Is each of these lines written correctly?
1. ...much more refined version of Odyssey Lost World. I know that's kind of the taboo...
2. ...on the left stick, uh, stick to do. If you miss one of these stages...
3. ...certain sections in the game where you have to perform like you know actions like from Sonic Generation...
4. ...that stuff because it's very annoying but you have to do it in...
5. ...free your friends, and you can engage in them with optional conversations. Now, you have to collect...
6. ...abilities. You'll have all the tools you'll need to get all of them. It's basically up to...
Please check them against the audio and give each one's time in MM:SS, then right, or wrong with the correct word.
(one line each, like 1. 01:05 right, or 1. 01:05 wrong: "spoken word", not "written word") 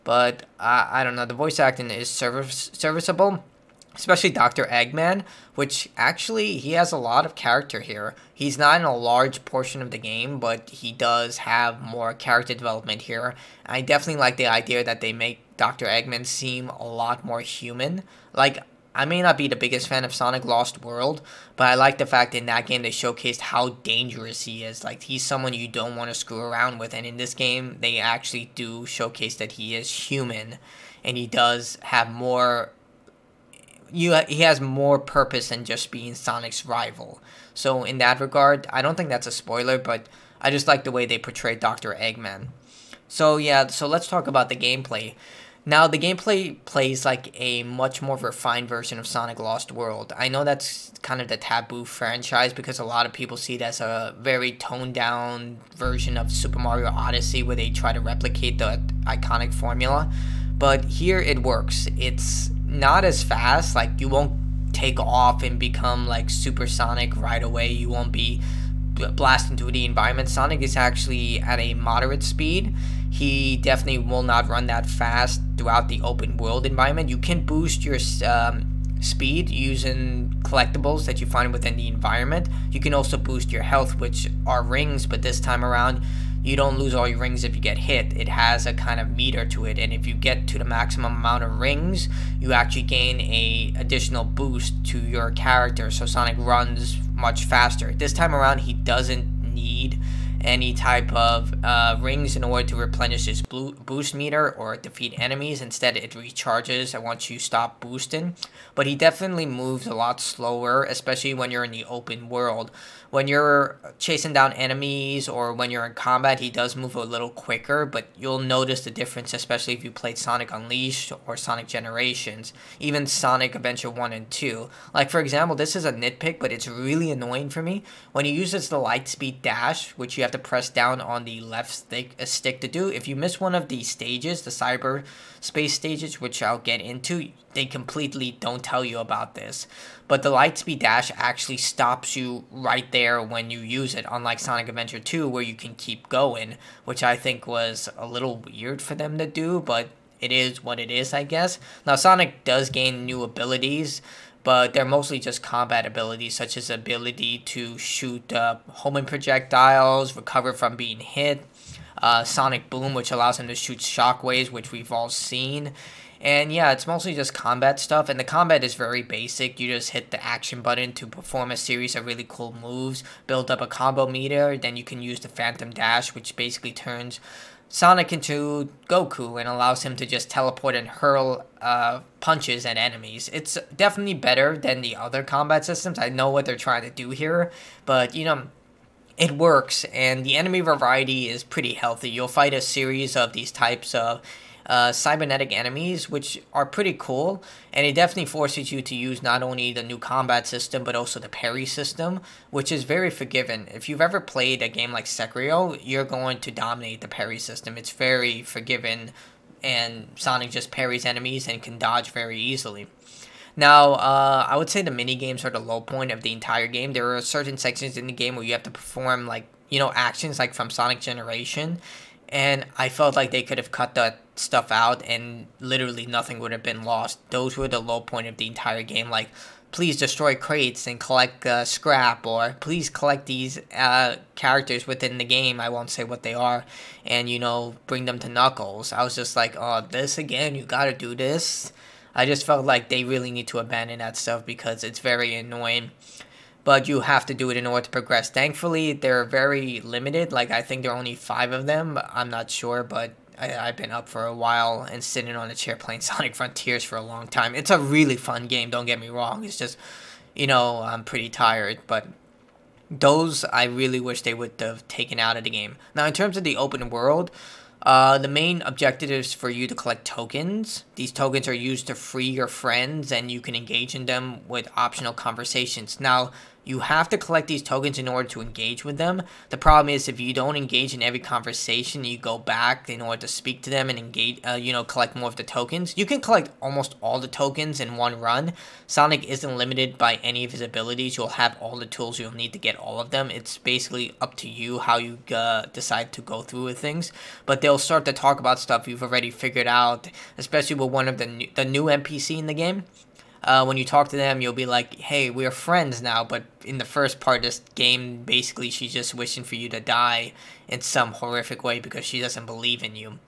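1. 00:47 wrong: "Sonic", not "Odyssey"
2. 02:10 right
3. 03:37 right
4. 04:03 right
5. 04:31 right
6. 04:50 right.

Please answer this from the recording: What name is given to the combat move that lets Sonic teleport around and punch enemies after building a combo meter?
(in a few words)
Phantom Dash.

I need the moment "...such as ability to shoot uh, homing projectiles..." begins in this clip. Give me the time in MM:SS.
02:36.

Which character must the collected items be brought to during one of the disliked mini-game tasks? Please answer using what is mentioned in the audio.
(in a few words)
Knuckles.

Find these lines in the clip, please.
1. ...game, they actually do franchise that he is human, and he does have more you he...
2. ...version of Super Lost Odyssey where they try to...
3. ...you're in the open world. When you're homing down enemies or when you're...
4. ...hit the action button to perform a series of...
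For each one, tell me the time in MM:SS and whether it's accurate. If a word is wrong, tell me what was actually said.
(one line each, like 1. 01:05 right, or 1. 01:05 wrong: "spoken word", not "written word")
1. 00:27 wrong: "showcase", not "franchise"
2. 00:55 wrong: "Mario", not "Lost"
3. 01:51 wrong: "chasing", not "homing"
4. 02:49 right.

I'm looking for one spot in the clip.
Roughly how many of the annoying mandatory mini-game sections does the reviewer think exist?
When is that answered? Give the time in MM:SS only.
04:11.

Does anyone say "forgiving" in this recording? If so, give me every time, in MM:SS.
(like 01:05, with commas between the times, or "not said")
03:23, 03:28.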